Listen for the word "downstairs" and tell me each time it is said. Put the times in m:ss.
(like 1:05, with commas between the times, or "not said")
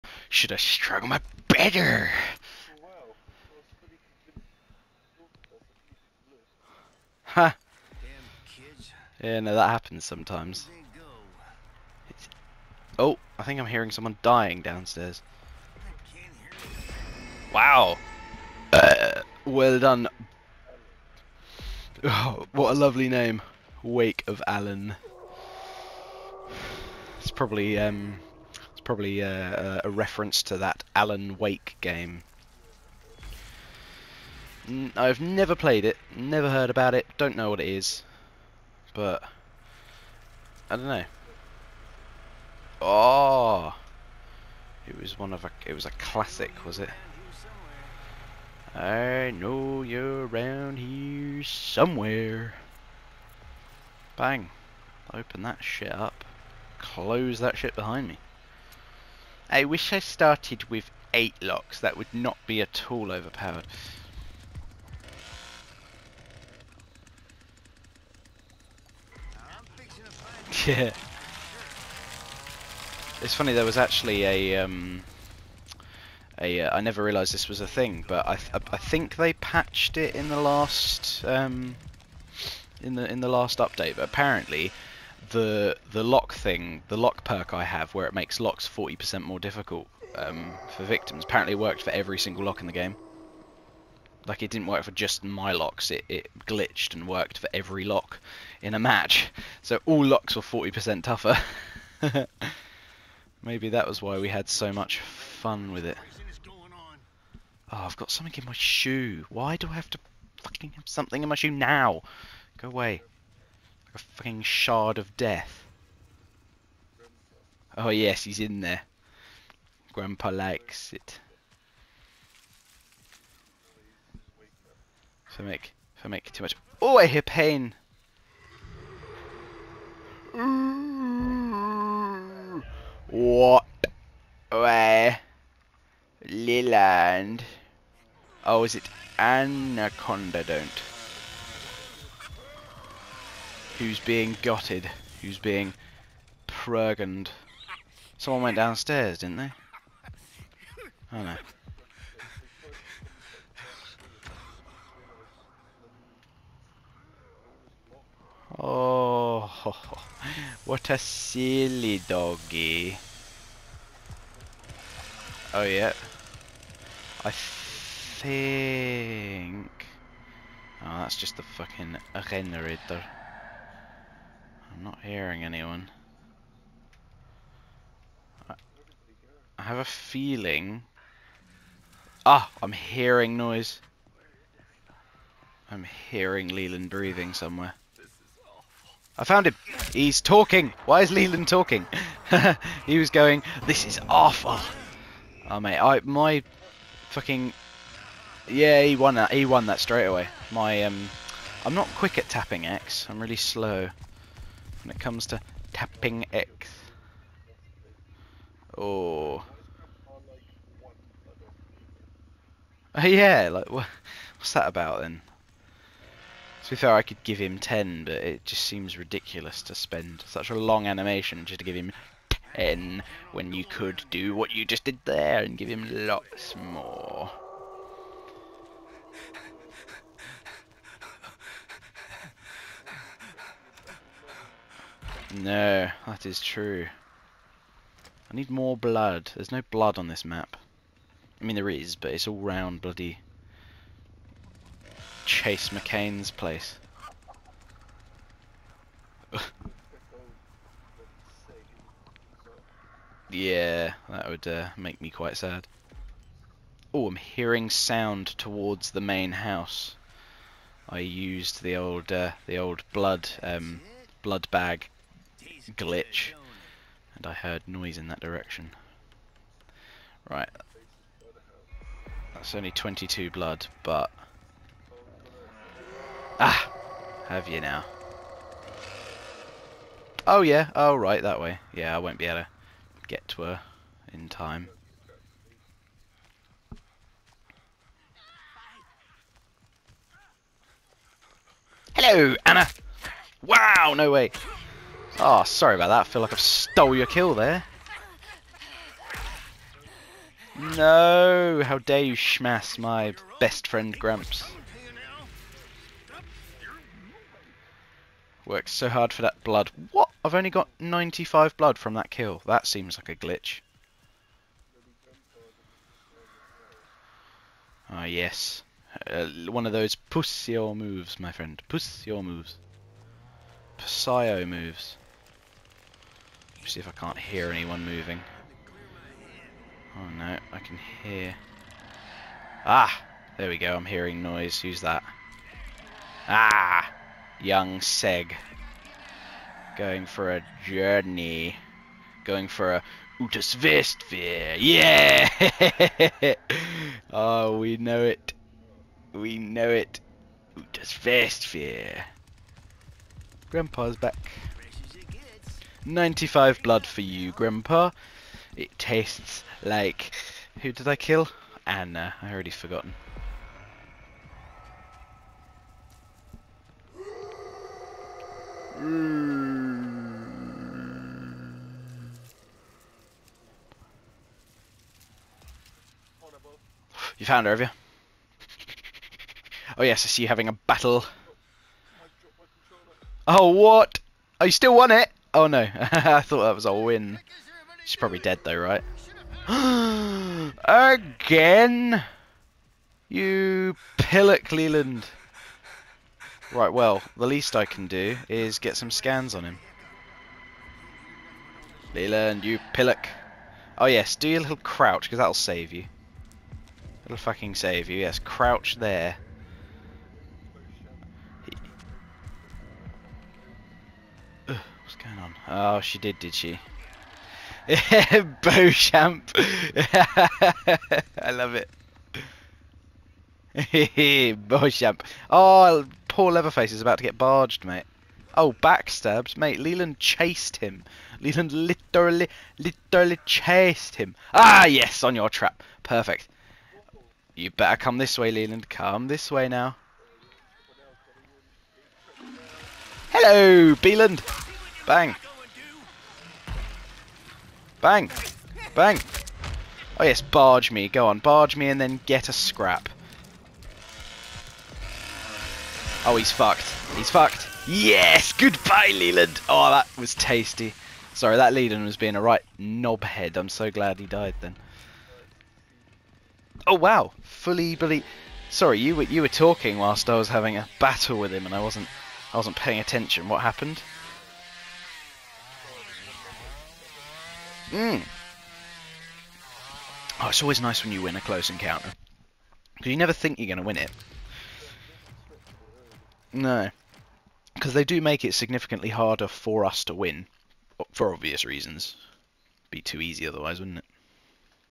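0:14, 2:28.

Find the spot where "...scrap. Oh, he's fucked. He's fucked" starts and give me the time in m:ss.
7:32.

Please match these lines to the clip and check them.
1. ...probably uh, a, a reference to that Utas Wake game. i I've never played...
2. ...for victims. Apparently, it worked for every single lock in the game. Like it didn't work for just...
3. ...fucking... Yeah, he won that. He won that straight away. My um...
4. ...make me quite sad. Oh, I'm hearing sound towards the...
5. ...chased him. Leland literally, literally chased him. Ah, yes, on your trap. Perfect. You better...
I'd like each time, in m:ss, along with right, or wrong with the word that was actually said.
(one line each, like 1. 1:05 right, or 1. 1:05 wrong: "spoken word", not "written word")
1. 0:28 wrong: "Alan", not "Utas"
2. 1:30 right
3. 3:17 right
4. 4:14 right
5. 7:09 right.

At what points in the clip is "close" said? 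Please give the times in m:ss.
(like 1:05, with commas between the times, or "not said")
0:56, 8:01.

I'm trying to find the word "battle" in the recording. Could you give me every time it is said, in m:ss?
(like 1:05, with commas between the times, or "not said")
6:20, 7:50.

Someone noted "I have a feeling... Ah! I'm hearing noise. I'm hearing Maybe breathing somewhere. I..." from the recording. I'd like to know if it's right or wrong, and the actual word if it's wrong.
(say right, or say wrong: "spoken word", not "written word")
wrong: "Leland", not "Maybe".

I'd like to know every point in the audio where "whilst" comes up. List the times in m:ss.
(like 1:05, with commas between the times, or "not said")
7:49.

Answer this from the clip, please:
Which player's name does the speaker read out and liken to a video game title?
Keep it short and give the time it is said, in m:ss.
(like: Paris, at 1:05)
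Wake of Alan, at 0:23.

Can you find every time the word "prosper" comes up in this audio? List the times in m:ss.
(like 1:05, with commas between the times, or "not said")
not said.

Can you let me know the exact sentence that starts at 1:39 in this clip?
So all locks were 40% tougher.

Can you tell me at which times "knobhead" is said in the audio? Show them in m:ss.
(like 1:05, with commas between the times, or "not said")
7:42.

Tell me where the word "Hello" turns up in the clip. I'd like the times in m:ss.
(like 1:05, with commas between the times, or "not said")
4:51, 7:23.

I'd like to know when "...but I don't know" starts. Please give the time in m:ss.
0:38.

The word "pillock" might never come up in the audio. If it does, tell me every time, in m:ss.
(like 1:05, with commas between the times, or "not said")
6:33, 6:42.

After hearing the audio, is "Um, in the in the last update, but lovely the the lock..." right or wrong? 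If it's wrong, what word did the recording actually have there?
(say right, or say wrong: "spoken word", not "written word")
wrong: "apparently", not "lovely".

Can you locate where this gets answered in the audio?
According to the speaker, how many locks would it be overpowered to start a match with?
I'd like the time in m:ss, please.
1:01.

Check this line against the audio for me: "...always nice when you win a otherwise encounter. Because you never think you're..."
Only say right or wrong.
wrong.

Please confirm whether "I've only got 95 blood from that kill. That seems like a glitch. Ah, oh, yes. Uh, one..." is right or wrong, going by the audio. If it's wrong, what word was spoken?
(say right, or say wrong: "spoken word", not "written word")
right.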